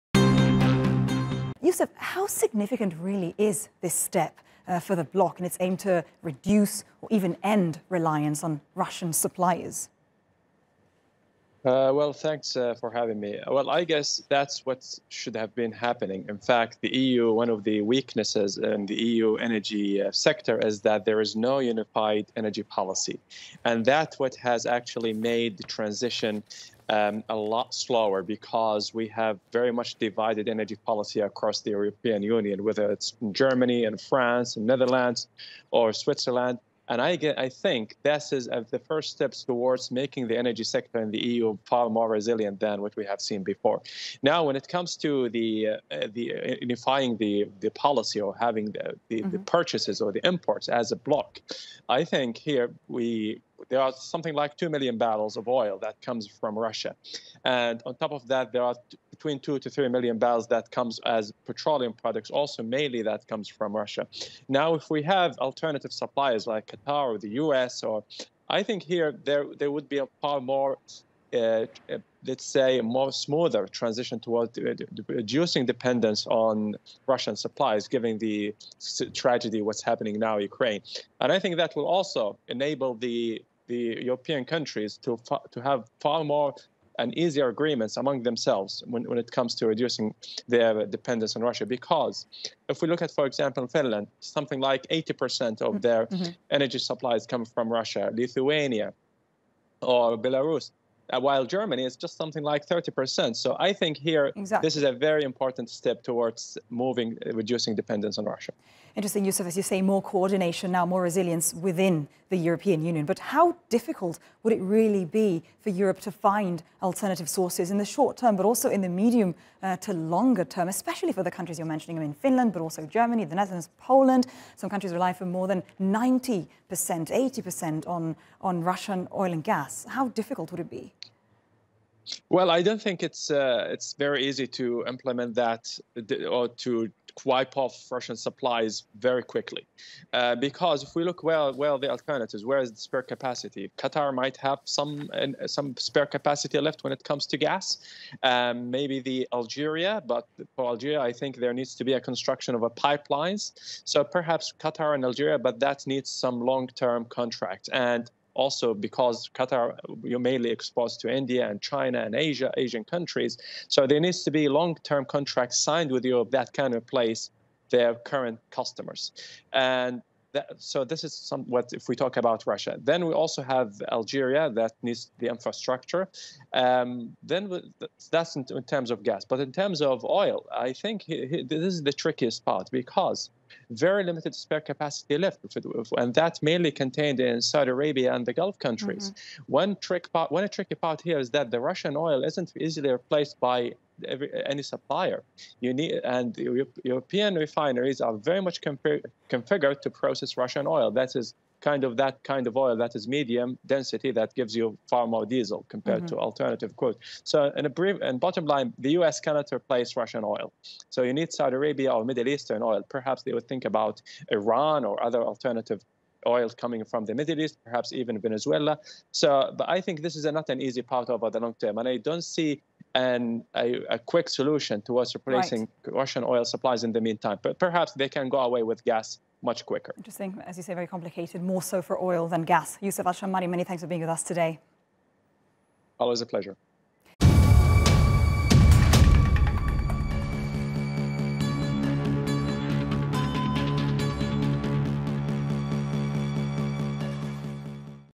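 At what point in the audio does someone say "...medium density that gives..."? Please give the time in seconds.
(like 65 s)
203 s.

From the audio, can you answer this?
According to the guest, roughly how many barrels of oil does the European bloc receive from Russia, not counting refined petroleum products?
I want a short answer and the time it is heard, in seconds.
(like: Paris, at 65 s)
2 million barrels, at 54 s.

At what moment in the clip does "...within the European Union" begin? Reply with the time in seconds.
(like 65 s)
111 s.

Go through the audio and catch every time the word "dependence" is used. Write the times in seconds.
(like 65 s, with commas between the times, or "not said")
75 s, 90 s, 107 s.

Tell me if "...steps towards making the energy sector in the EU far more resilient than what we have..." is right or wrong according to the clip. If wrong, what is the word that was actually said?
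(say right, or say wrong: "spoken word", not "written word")
right.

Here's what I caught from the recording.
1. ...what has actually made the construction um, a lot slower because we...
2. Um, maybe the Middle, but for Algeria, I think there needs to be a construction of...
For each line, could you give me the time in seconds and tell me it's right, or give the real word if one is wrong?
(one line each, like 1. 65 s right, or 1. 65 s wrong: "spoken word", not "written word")
1. 24 s wrong: "transition", not "construction"
2. 148 s wrong: "Algeria", not "Middle".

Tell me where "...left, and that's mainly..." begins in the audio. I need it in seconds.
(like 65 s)
185 s.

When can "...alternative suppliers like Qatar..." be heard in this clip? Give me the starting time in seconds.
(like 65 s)
65 s.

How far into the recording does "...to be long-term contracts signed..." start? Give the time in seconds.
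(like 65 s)
164 s.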